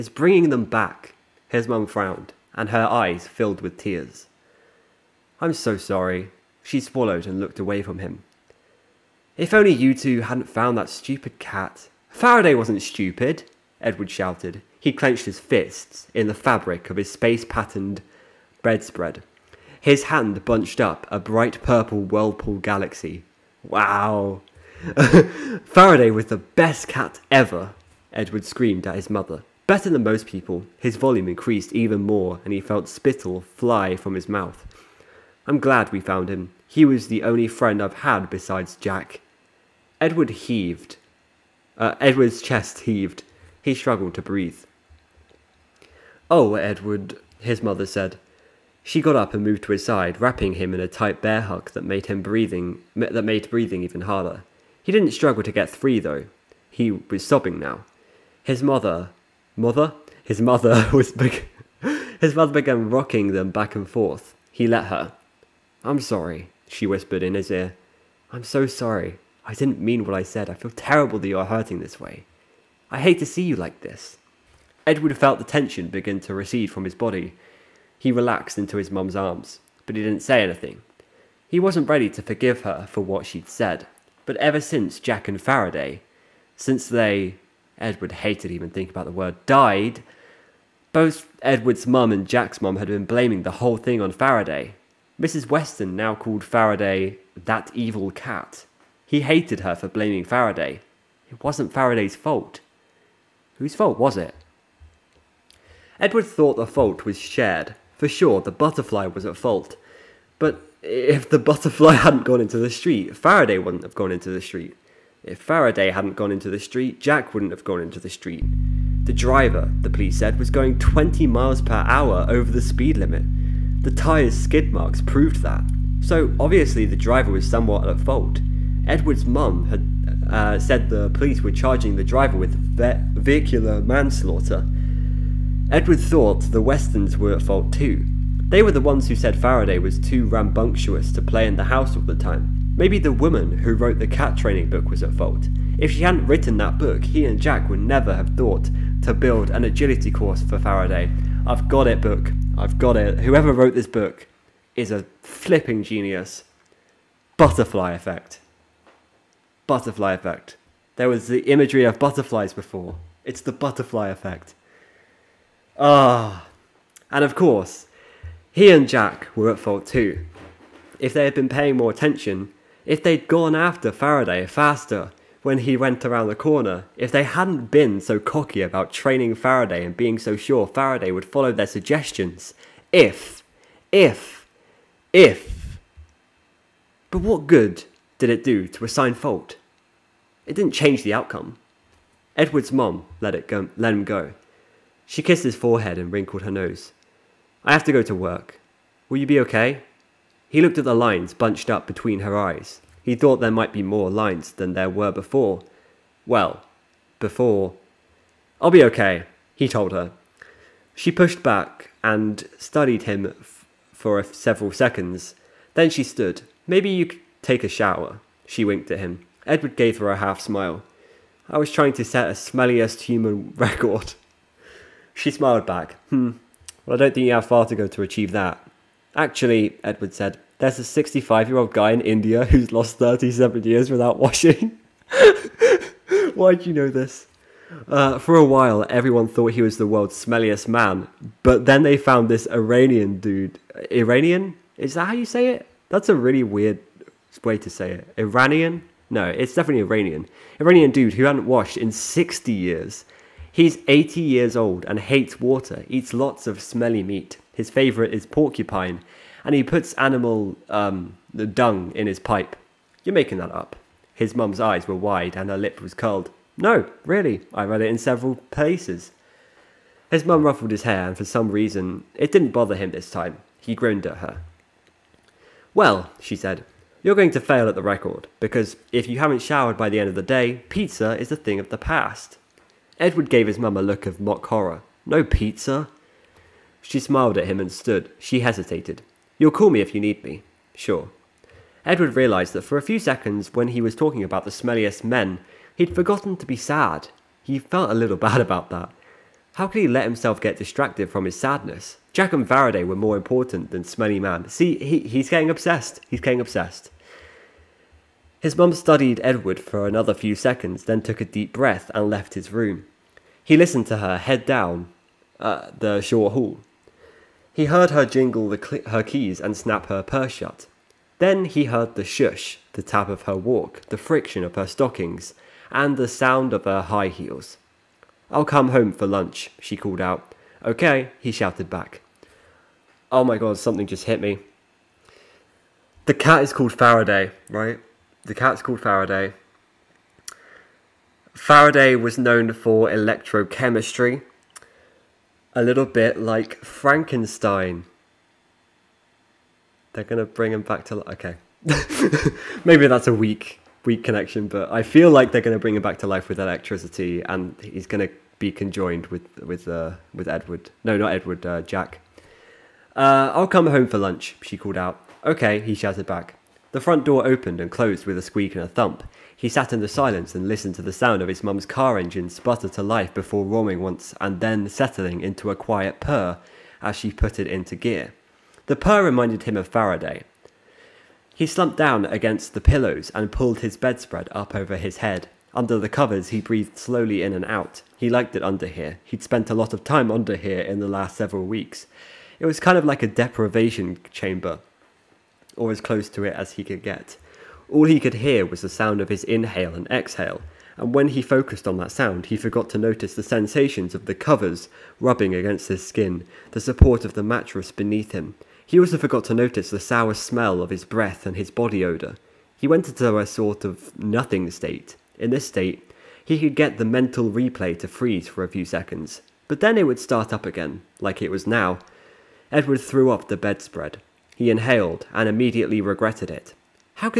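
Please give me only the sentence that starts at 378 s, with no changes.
The purr reminded him of Faraday.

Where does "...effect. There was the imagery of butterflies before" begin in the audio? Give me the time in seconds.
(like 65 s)
160 s.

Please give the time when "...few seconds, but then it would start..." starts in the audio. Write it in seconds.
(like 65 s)
418 s.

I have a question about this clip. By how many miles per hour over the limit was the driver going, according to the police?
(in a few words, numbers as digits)
20.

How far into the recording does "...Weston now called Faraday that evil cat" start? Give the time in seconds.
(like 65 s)
95 s.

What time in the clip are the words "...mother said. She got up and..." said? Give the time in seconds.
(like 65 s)
47 s.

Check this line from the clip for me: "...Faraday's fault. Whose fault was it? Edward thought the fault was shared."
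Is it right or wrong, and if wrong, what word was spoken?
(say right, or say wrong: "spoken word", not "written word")
right.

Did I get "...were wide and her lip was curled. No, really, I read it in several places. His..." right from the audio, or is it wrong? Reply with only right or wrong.
right.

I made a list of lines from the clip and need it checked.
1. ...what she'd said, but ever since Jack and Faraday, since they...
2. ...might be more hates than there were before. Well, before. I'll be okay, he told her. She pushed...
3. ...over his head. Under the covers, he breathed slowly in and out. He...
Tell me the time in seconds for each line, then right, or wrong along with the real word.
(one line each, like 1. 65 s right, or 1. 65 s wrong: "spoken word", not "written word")
1. 82 s right
2. 203 s wrong: "lines", not "hates"
3. 384 s right.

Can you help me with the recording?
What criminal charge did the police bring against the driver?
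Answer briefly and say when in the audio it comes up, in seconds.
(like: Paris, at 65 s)
vehicular manslaughter, at 133 s.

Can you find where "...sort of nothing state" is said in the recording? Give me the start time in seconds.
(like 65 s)
413 s.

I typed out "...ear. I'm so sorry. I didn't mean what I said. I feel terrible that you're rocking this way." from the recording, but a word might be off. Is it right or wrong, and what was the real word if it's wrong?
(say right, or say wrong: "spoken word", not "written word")
wrong: "hurting", not "rocking".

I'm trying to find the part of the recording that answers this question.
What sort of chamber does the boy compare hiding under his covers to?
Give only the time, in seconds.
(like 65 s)
393 s.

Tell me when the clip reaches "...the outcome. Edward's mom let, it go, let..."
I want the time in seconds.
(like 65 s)
191 s.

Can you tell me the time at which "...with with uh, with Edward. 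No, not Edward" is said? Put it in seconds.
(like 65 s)
359 s.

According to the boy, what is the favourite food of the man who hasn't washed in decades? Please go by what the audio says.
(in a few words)
porcupine.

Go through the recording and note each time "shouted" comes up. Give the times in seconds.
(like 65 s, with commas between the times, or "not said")
14 s, 331 s, 365 s.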